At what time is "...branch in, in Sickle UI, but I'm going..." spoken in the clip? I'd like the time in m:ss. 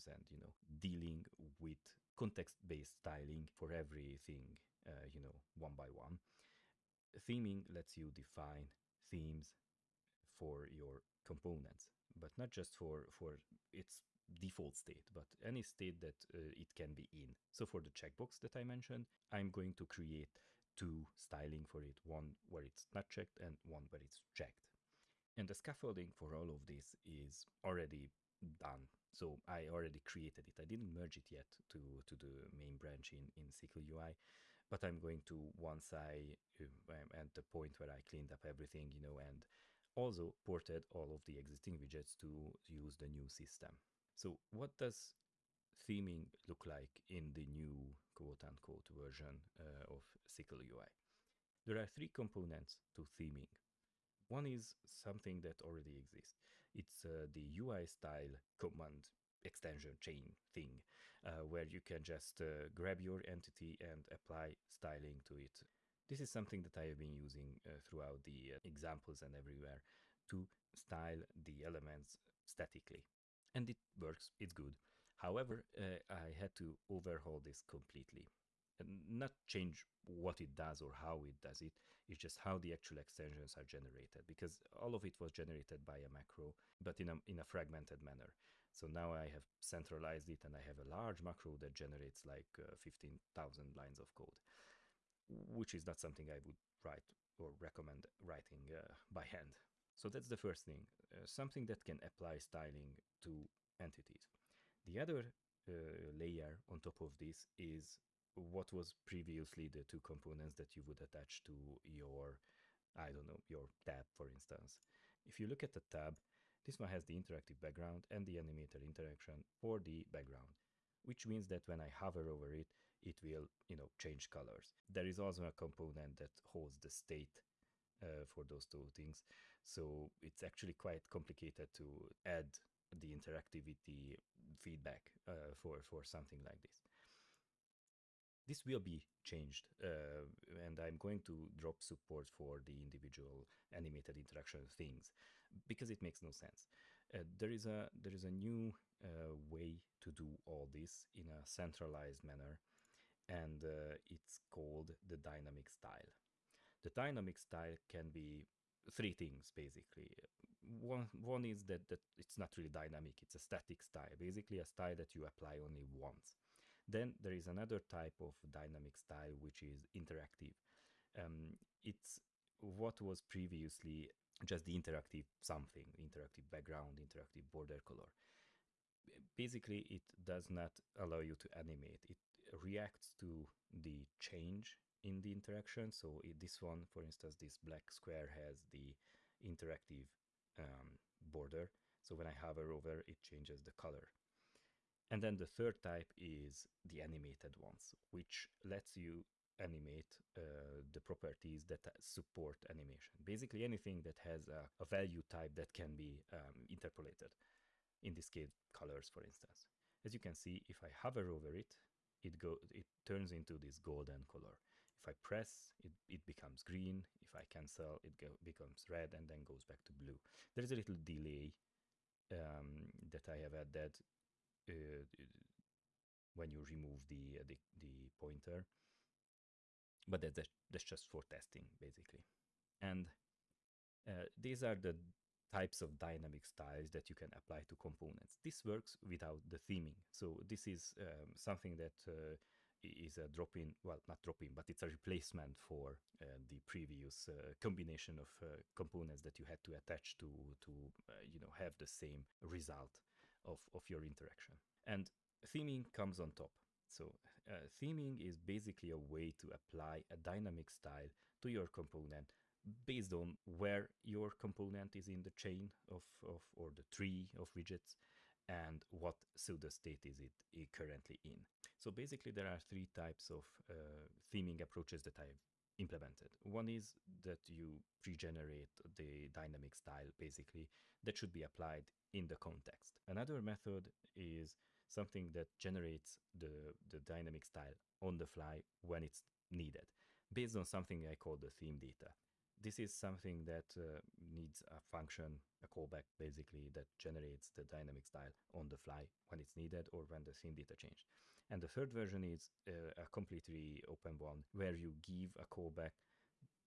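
0:32.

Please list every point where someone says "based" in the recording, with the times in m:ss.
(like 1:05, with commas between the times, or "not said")
0:02, 4:22, 4:50.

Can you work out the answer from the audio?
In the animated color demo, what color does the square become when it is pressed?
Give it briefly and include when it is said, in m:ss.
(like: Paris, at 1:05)
Green, at 3:36.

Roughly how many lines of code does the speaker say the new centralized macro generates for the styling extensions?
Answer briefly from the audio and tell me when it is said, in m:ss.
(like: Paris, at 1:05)
15000, at 1:32.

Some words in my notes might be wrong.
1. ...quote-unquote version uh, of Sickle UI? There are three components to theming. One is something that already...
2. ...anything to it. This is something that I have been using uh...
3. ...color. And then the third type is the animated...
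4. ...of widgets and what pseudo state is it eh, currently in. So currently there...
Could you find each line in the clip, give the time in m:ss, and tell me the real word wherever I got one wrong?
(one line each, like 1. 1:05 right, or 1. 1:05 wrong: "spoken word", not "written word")
1. 0:48 right
2. 1:04 wrong: "styling", not "anything"
3. 3:13 right
4. 4:27 wrong: "basically", not "currently".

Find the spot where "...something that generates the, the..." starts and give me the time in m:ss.
4:44.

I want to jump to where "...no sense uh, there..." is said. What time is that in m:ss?
2:26.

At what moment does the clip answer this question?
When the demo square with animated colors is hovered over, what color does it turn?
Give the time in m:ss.
3:33.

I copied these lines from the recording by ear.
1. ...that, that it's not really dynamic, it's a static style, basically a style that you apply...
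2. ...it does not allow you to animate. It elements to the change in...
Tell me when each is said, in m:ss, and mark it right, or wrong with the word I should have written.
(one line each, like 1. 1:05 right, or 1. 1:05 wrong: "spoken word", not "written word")
1. 2:41 right
2. 2:59 wrong: "reacts", not "elements".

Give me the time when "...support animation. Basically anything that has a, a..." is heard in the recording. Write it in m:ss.
3:21.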